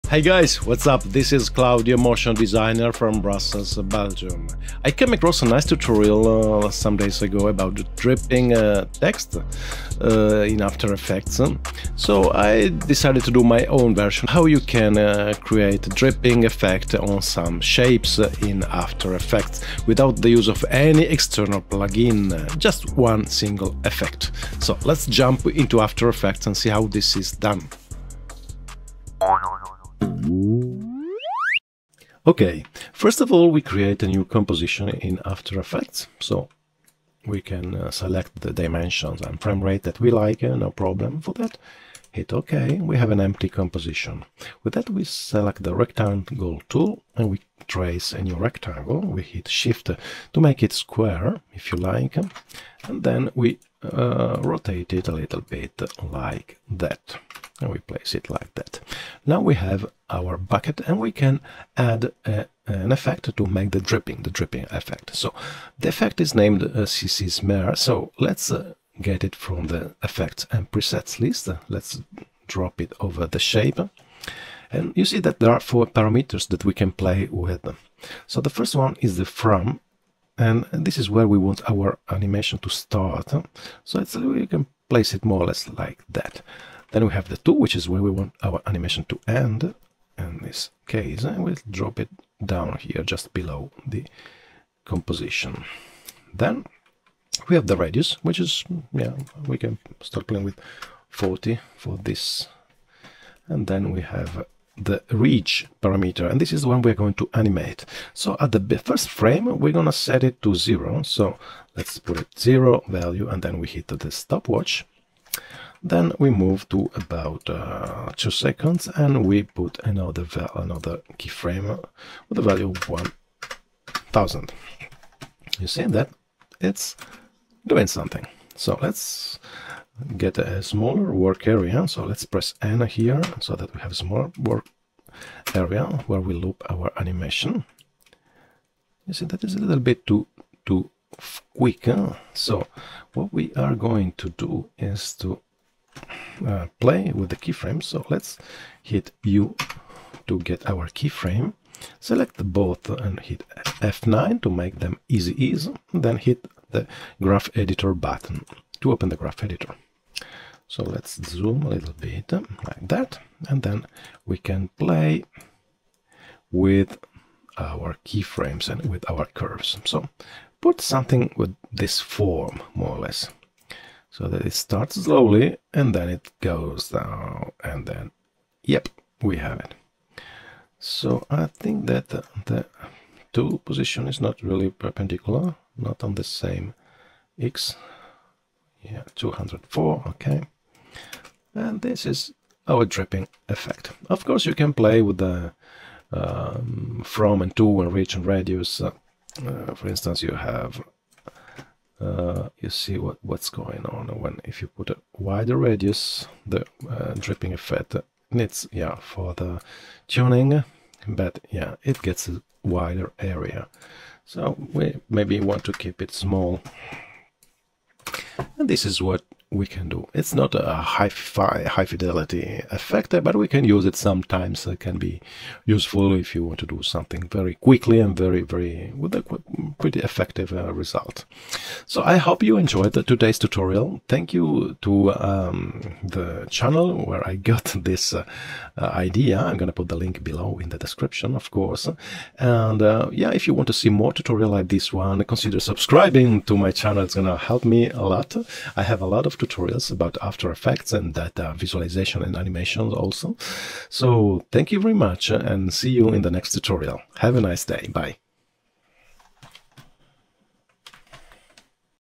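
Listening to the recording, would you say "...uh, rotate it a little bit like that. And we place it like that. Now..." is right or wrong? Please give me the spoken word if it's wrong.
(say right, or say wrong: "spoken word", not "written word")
right.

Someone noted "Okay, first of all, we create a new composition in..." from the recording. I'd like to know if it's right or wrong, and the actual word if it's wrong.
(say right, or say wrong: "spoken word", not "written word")
right.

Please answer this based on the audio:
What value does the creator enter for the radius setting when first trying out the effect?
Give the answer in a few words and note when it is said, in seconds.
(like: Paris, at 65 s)
40, at 101 s.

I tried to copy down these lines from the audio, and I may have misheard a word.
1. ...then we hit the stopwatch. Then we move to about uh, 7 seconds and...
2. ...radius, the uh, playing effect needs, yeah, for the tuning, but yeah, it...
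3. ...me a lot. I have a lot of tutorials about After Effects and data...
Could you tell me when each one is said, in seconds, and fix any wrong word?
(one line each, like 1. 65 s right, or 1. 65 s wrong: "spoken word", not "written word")
1. 113 s wrong: "2", not "7"
2. 205 s wrong: "dripping", not "playing"
3. 247 s right.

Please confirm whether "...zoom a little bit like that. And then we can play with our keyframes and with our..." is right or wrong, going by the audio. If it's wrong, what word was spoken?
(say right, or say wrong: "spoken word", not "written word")
right.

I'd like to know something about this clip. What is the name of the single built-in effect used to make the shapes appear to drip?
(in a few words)
CC Smear.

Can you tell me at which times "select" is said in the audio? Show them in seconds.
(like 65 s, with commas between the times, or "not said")
37 s, 45 s, 151 s.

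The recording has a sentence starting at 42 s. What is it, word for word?
Hit OK, we have an empty composition.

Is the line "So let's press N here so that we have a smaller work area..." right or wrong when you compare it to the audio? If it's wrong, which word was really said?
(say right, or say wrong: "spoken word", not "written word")
right.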